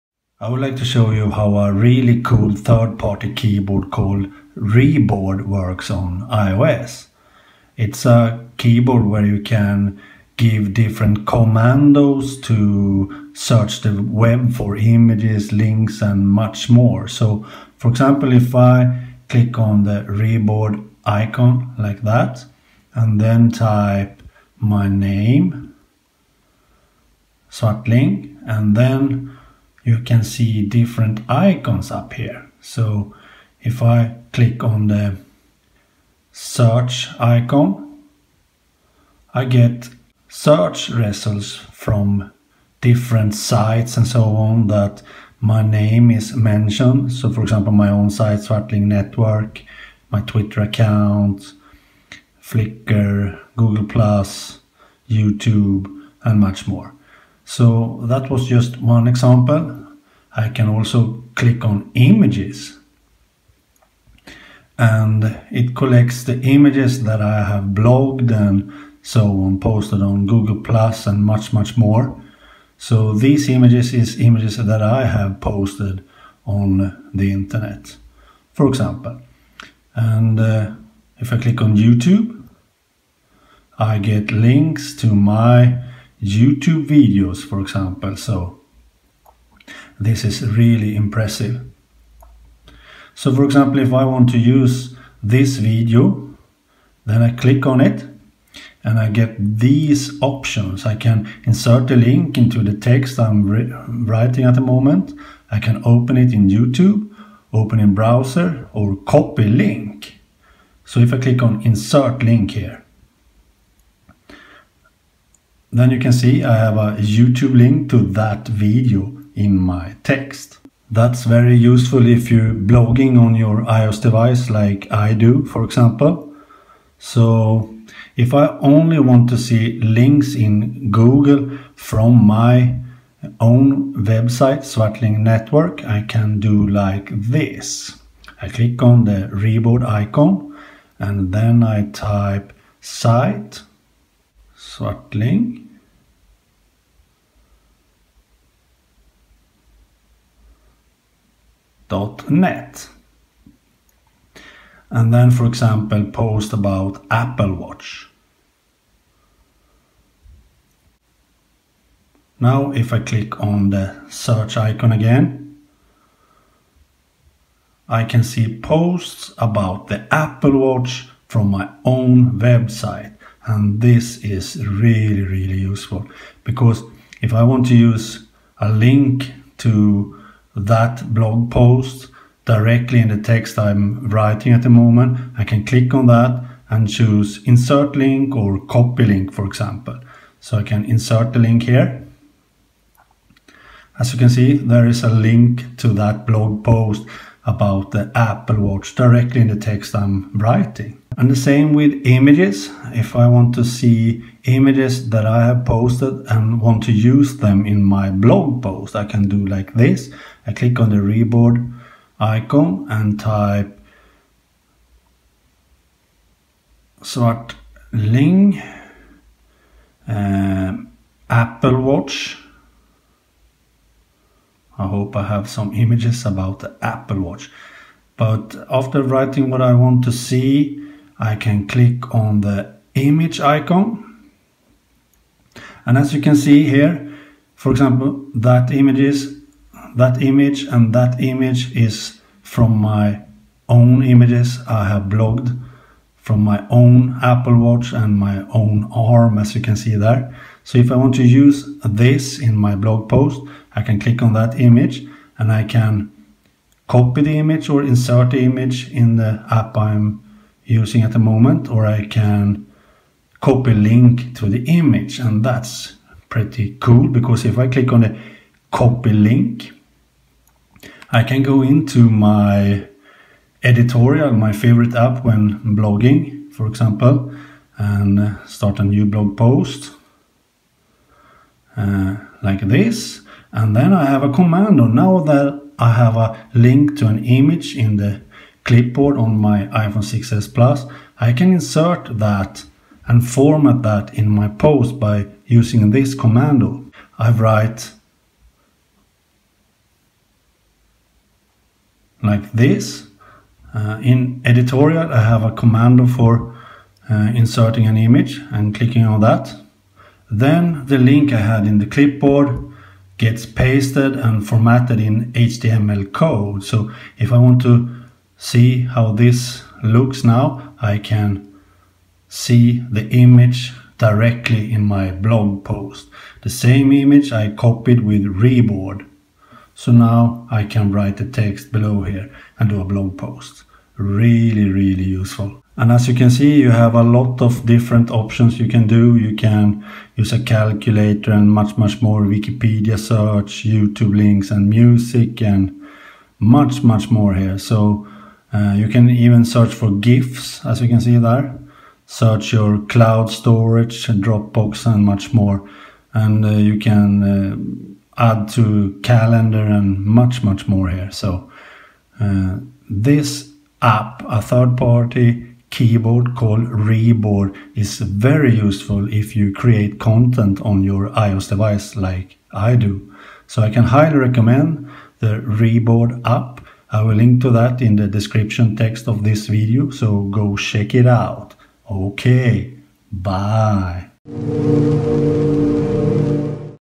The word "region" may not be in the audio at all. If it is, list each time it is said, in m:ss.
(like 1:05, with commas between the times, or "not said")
not said.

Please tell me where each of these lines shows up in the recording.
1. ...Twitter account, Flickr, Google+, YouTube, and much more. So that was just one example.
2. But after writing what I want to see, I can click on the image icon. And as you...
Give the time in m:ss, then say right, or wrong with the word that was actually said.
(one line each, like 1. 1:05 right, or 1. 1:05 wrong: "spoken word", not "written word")
1. 0:50 right
2. 3:48 right.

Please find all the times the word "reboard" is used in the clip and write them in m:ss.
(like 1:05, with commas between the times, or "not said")
0:04, 0:20, 2:19, 3:30, 5:28, 6:06, 6:15.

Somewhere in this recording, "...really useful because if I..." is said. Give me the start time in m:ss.
2:55.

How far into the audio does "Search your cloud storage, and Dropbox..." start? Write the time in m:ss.
5:52.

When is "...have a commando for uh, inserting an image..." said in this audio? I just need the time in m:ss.
5:05.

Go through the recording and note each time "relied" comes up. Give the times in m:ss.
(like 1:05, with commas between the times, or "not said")
not said.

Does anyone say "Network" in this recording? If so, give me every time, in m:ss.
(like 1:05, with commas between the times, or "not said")
0:48, 2:15.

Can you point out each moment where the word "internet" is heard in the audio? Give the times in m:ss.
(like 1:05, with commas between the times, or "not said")
1:17.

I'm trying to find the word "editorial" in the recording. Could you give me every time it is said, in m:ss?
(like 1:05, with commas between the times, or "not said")
4:33, 5:04.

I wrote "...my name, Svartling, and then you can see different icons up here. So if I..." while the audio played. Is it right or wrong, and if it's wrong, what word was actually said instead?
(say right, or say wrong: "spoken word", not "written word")
right.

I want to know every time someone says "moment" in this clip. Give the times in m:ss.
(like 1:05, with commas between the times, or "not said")
1:44, 3:04, 4:21.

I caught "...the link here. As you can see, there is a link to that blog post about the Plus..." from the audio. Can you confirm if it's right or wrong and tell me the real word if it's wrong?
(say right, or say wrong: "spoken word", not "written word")
wrong: "Apple", not "Plus".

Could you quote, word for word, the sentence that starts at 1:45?
I can open it in YouTube, open in browser or copy link.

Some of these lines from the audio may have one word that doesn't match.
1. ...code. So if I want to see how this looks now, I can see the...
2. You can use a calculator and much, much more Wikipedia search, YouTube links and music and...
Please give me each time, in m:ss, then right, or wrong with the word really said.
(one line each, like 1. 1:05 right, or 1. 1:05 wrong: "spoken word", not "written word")
1. 5:16 right
2. 5:39 right.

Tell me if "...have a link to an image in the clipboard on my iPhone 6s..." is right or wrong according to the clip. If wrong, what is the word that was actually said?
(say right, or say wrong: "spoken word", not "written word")
right.